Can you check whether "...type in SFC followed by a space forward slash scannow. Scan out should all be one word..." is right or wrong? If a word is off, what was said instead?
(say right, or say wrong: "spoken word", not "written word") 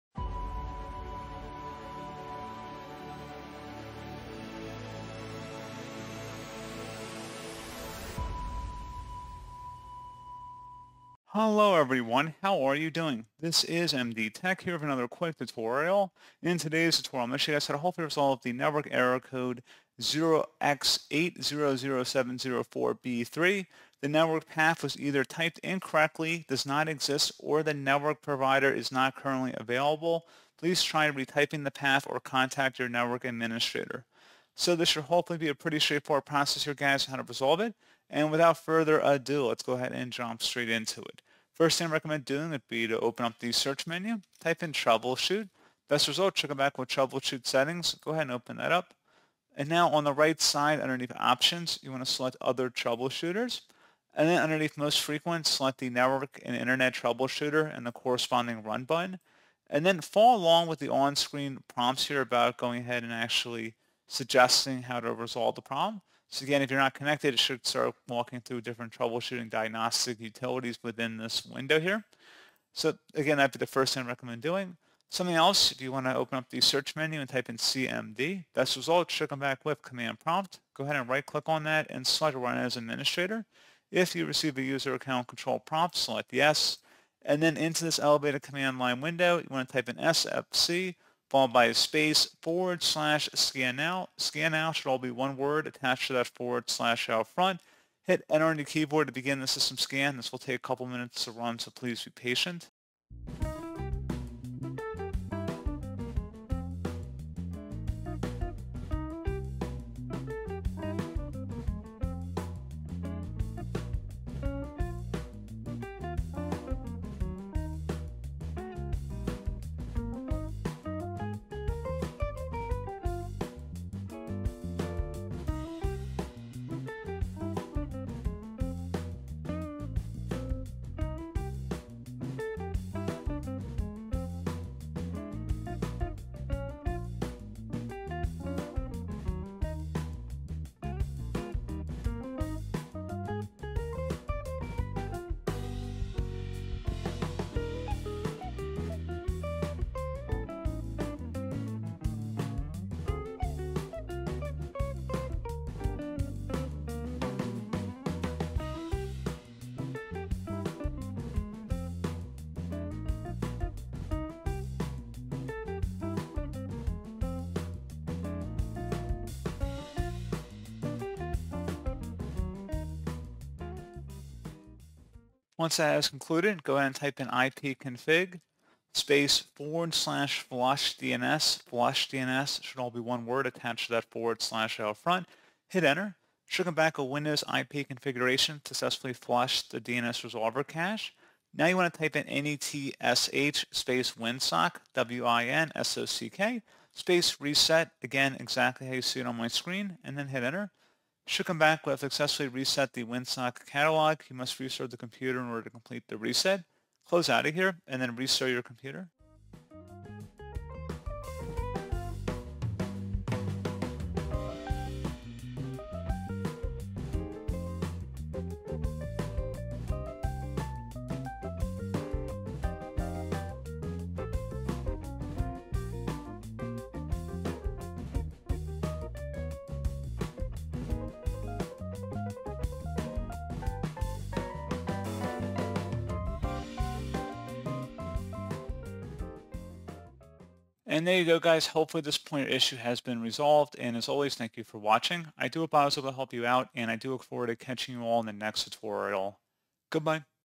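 right.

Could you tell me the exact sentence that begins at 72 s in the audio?
So again, that'd be the first thing I recommend doing.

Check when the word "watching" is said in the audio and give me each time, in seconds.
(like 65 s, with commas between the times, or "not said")
244 s.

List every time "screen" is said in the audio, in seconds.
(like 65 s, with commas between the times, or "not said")
60 s, 199 s.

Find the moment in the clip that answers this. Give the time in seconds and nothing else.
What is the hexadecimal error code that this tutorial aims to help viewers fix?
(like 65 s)
20 s.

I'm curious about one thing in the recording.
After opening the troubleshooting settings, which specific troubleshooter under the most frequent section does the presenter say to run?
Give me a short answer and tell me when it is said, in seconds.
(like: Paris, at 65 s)
Network and internet troubleshooter, at 55 s.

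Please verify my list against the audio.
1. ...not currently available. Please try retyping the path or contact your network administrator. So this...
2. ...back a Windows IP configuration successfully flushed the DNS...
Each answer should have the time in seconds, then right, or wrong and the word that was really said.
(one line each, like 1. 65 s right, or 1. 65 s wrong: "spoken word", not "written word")
1. 28 s right
2. 186 s right.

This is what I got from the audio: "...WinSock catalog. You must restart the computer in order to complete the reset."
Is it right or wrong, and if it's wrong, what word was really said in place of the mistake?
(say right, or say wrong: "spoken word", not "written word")
right.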